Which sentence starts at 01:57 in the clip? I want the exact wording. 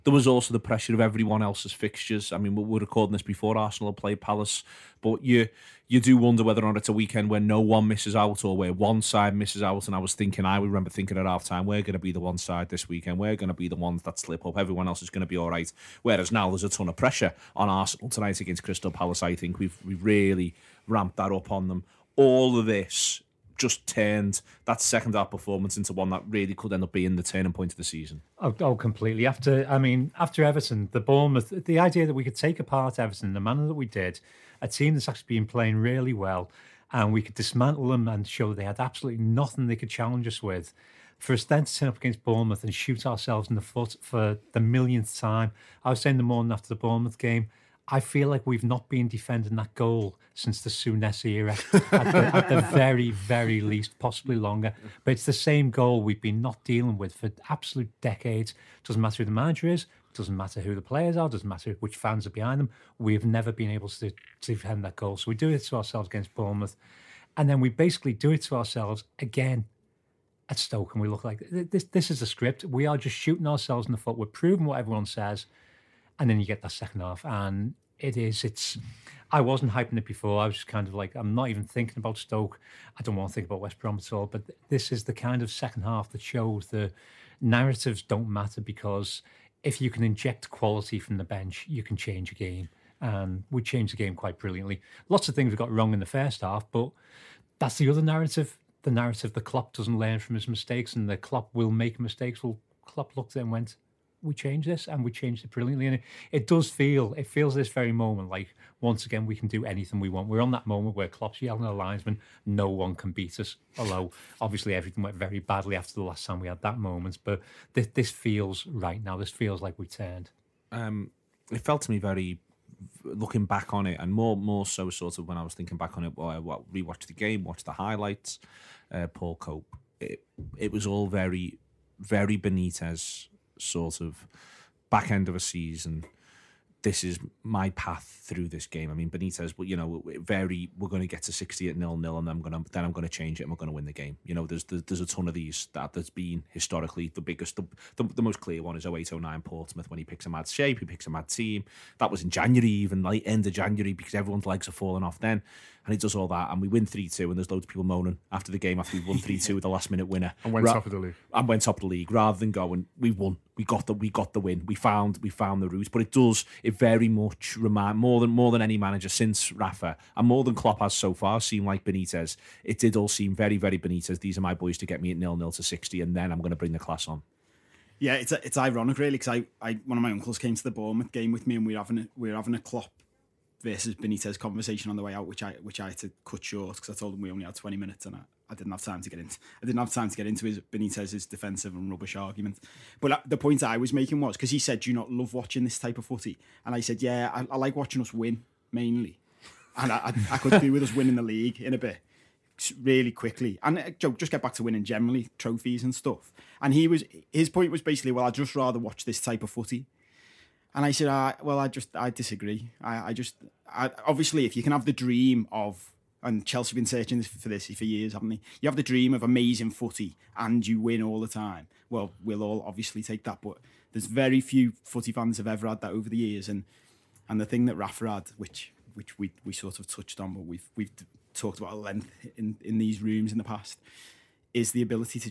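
But this, this feels right now.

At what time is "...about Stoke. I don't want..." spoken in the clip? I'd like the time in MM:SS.
01:21.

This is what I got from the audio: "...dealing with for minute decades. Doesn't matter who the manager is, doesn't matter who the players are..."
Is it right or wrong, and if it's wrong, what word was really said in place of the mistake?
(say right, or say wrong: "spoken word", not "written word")
wrong: "absolute", not "minute".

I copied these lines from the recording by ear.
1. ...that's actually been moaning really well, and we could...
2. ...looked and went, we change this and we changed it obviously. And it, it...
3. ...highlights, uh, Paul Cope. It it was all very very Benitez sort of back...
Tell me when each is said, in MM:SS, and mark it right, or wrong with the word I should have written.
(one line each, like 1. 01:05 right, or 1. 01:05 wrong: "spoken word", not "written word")
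1. 00:34 wrong: "playing", not "moaning"
2. 01:43 wrong: "brilliantly", not "obviously"
3. 02:07 right.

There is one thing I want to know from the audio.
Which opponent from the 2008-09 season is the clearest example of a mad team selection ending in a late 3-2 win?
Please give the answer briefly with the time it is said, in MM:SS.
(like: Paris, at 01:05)
Portsmouth, at 02:29.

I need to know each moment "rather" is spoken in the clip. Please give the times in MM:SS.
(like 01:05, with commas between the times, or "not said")
02:42, 03:28.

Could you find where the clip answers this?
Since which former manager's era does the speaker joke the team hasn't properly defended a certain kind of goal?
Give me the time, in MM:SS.
00:50.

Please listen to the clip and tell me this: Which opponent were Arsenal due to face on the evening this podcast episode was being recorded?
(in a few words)
Crystal Palace.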